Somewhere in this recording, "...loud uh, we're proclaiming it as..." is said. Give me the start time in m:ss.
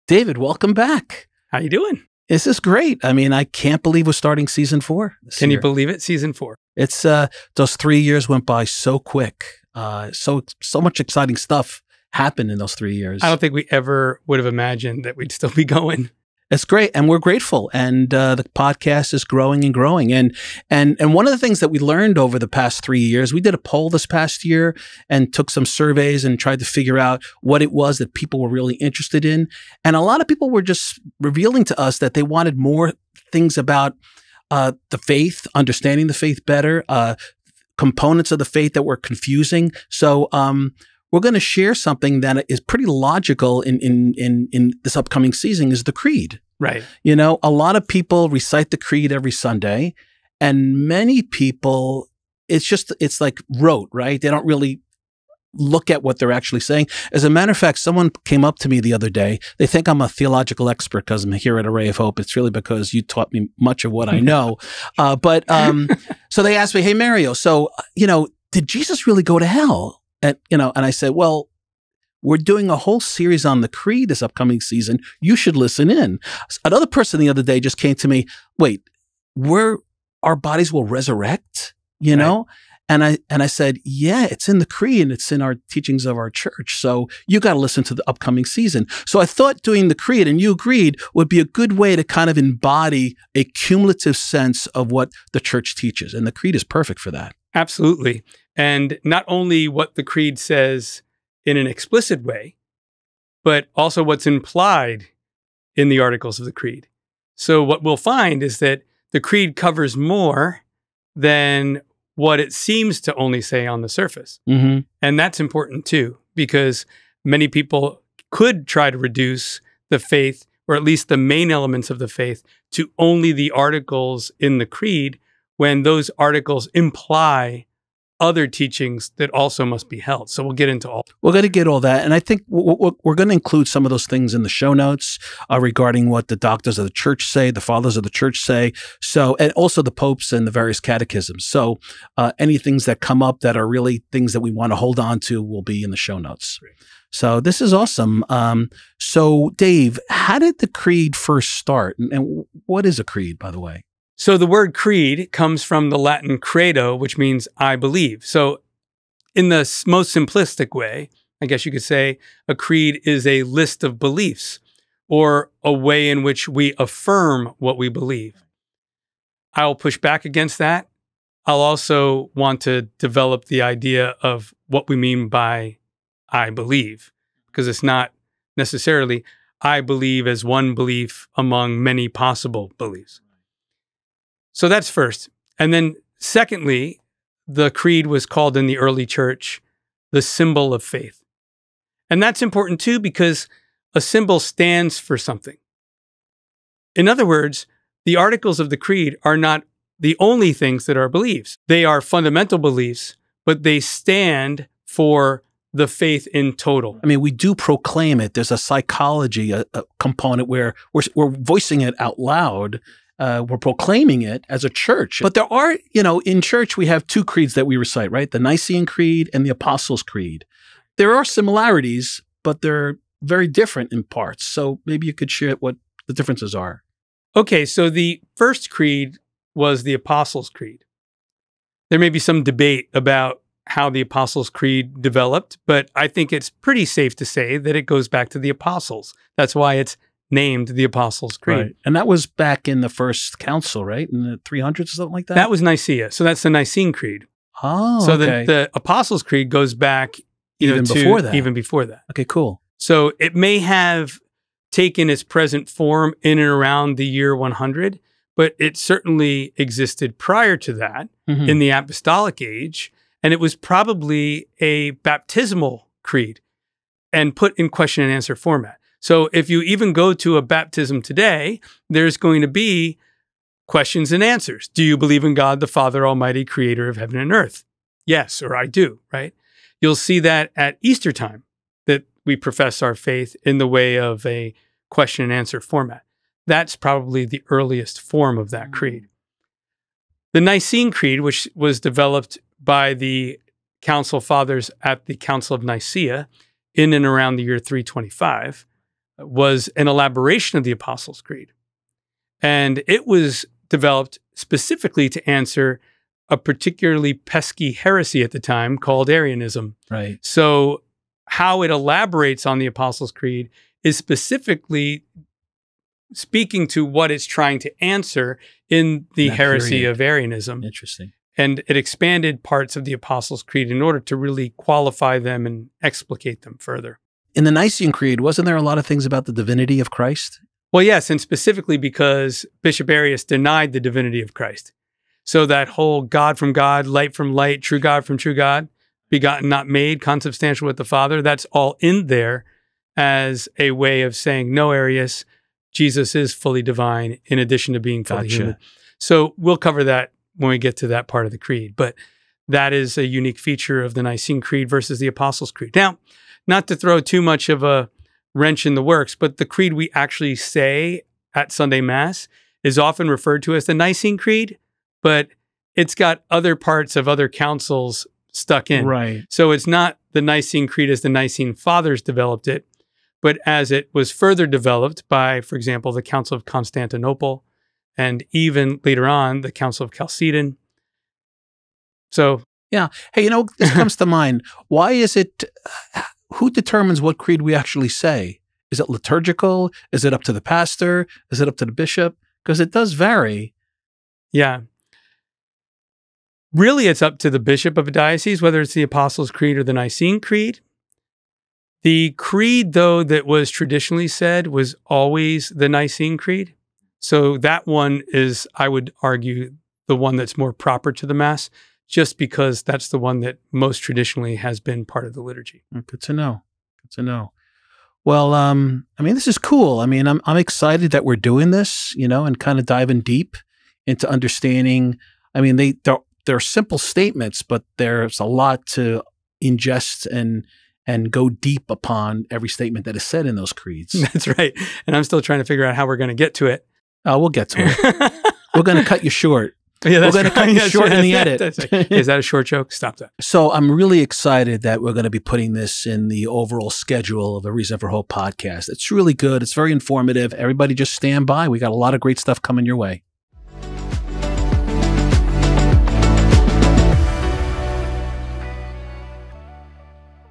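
3:32.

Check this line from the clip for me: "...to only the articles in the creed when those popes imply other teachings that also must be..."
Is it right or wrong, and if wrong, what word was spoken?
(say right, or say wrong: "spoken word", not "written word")
wrong: "articles", not "popes".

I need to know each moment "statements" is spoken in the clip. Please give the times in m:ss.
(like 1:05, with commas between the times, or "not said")
7:06, 7:12.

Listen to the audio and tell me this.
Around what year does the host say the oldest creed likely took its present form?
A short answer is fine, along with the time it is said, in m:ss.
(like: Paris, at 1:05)
100, at 4:16.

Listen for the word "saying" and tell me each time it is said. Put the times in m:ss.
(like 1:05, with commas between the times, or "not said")
0:56, 5:44.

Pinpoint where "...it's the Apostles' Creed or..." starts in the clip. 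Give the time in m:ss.
6:38.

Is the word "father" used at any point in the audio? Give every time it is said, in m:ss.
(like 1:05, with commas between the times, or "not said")
2:17, 4:35, 4:54, 5:40, 6:11.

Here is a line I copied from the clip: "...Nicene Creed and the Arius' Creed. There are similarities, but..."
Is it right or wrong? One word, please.
wrong.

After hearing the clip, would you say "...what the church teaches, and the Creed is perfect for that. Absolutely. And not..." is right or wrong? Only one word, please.
right.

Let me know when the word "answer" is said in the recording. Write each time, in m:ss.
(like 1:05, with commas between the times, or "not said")
4:28, 4:34, 4:45, 5:05, 5:17.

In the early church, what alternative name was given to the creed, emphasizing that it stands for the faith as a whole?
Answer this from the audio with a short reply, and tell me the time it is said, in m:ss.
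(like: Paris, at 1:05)
symbol of faith, at 3:10.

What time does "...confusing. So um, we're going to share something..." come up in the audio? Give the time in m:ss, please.
0:38.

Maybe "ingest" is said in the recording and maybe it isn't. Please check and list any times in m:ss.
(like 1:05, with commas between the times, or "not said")
7:09.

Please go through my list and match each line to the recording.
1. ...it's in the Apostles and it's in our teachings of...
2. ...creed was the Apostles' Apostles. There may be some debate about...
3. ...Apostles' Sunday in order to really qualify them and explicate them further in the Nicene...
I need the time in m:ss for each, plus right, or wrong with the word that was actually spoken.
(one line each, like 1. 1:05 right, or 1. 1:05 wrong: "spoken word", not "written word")
1. 1:24 wrong: "Creed", not "Apostles"
2. 3:48 wrong: "Creed", not "Apostles"
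3. 5:22 wrong: "Creed", not "Sunday".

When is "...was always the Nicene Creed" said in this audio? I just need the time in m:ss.
6:44.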